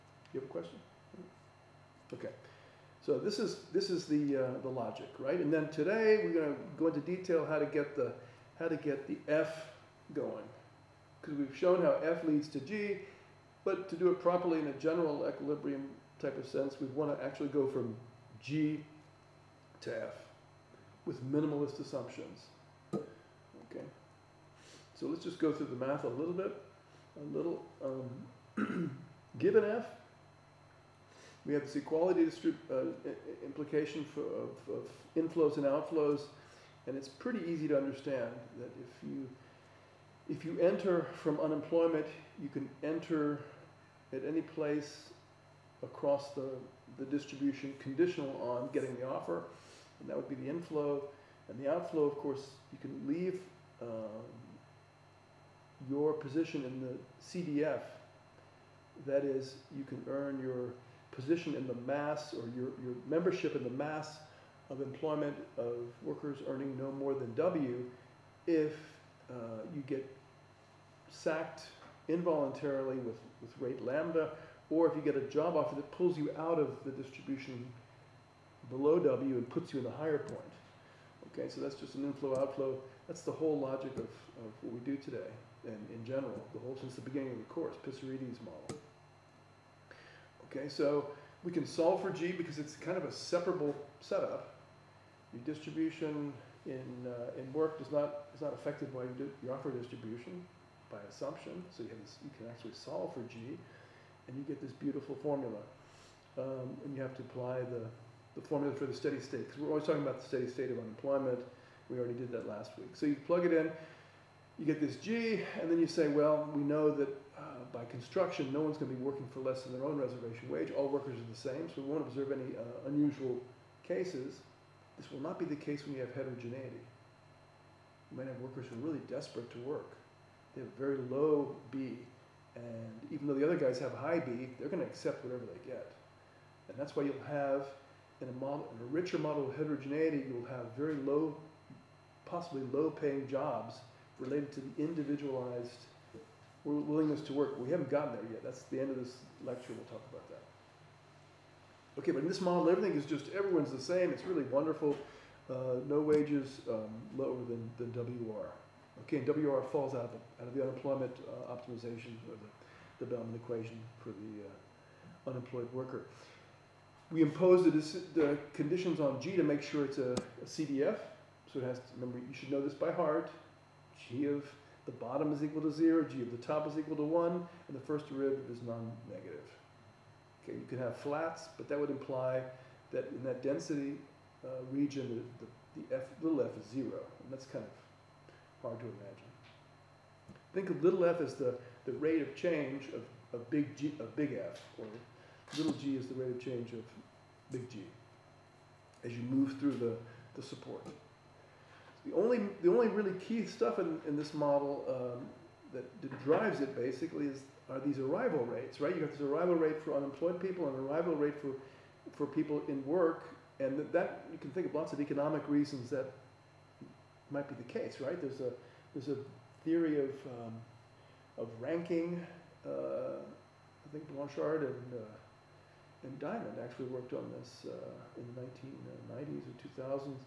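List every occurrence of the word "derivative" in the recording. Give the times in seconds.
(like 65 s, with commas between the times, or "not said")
178 s.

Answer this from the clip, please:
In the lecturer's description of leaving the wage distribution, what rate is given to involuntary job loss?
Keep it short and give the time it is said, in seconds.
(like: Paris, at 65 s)
lambda, at 73 s.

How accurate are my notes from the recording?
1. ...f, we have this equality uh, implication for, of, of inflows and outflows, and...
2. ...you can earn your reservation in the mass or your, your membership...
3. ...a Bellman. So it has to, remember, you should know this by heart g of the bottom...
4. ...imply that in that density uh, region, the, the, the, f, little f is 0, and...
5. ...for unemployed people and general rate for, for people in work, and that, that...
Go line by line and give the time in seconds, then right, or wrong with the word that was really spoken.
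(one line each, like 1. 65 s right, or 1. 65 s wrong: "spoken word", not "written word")
1. 29 s right
2. 59 s wrong: "position", not "reservation"
3. 170 s wrong: "CDF", not "Bellman"
4. 181 s right
5. 209 s wrong: "arrival", not "general".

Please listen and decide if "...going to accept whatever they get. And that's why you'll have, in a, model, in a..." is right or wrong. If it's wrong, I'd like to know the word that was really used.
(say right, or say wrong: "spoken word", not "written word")
right.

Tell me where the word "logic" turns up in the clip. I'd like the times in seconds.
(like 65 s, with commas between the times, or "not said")
4 s, 83 s.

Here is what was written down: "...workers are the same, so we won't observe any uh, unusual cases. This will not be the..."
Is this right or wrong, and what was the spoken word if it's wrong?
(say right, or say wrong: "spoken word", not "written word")
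right.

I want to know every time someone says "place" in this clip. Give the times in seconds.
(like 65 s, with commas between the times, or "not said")
44 s.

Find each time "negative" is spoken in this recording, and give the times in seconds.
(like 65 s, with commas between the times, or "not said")
178 s.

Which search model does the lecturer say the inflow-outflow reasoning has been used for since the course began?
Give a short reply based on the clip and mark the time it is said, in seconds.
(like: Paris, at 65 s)
Pissarides model, at 87 s.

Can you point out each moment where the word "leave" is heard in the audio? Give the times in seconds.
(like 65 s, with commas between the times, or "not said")
53 s.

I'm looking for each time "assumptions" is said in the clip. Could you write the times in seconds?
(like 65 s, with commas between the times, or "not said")
21 s, 101 s.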